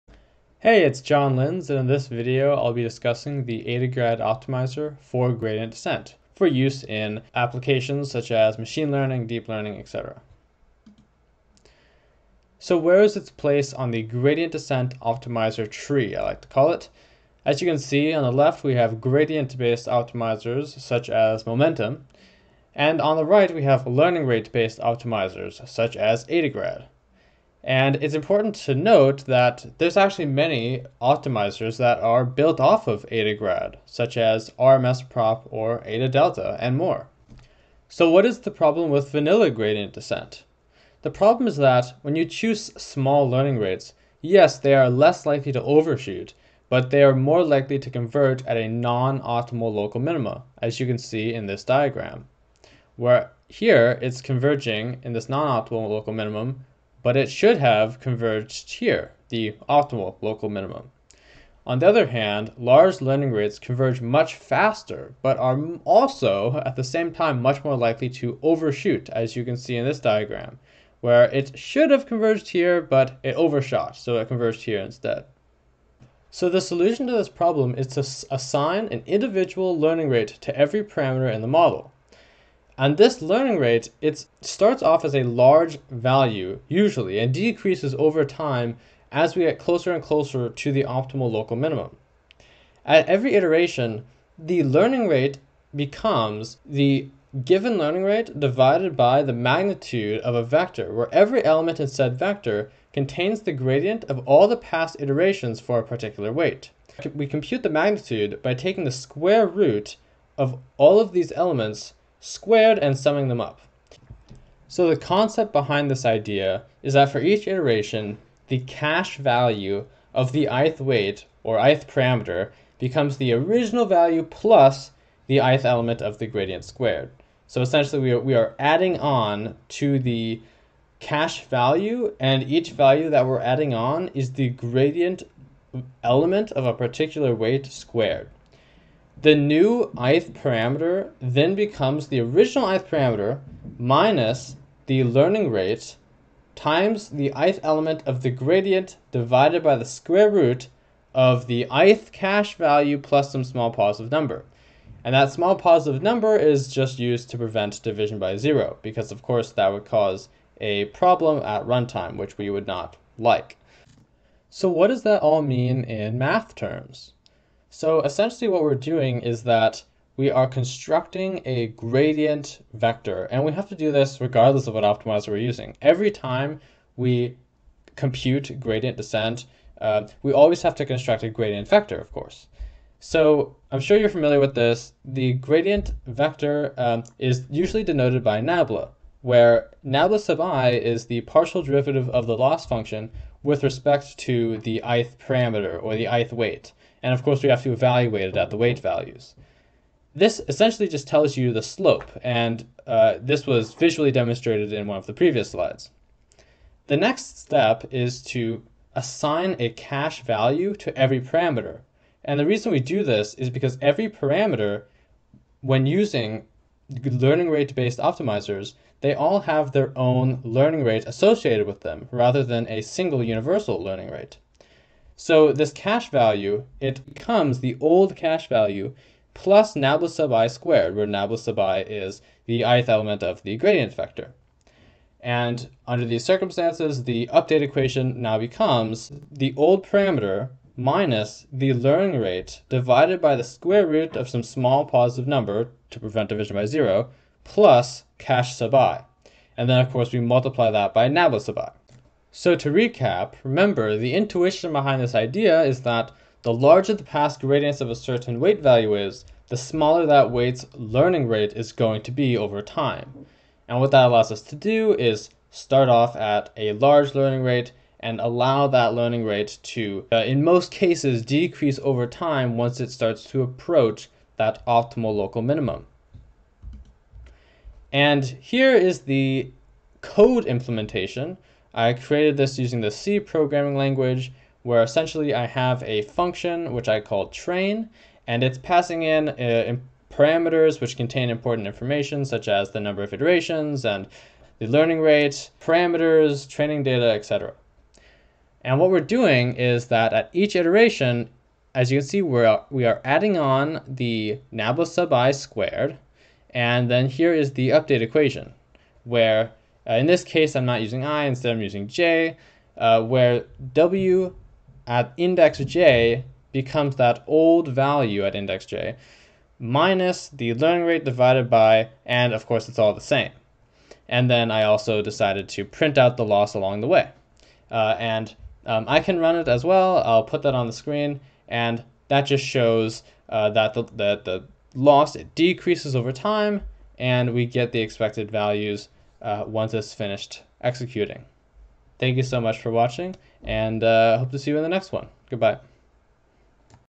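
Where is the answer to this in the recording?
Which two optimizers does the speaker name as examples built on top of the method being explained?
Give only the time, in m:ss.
0:34.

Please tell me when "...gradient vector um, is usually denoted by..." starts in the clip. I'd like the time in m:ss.
3:05.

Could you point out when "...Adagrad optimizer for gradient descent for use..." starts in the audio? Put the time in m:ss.
0:03.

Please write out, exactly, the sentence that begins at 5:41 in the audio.
Thank you so much for watching, and uh, hope to see you in the next one.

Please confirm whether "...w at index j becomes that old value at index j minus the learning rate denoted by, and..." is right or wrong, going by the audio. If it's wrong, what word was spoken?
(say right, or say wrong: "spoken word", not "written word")
wrong: "divided", not "denoted".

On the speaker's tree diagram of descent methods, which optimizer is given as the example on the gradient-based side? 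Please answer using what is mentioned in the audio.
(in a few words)
momentum.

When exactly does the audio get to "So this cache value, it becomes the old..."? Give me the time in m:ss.
3:45.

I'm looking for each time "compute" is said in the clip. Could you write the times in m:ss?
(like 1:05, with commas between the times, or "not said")
1:47, 2:57.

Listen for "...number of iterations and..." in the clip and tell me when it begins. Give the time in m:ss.
4:52.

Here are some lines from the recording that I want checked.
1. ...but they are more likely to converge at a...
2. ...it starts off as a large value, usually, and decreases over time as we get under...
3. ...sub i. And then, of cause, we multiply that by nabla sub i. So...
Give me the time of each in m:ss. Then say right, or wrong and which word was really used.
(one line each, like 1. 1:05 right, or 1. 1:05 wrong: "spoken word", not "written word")
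1. 0:46 right
2. 1:24 wrong: "closer", not "under"
3. 4:08 wrong: "course", not "cause".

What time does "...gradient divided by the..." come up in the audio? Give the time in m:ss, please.
2:28.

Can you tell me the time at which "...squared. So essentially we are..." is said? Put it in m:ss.
2:06.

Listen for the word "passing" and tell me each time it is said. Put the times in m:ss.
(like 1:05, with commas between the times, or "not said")
4:48.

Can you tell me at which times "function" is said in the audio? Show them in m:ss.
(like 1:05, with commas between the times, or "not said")
3:12, 4:46.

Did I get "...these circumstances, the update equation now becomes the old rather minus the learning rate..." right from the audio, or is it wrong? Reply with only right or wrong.
wrong.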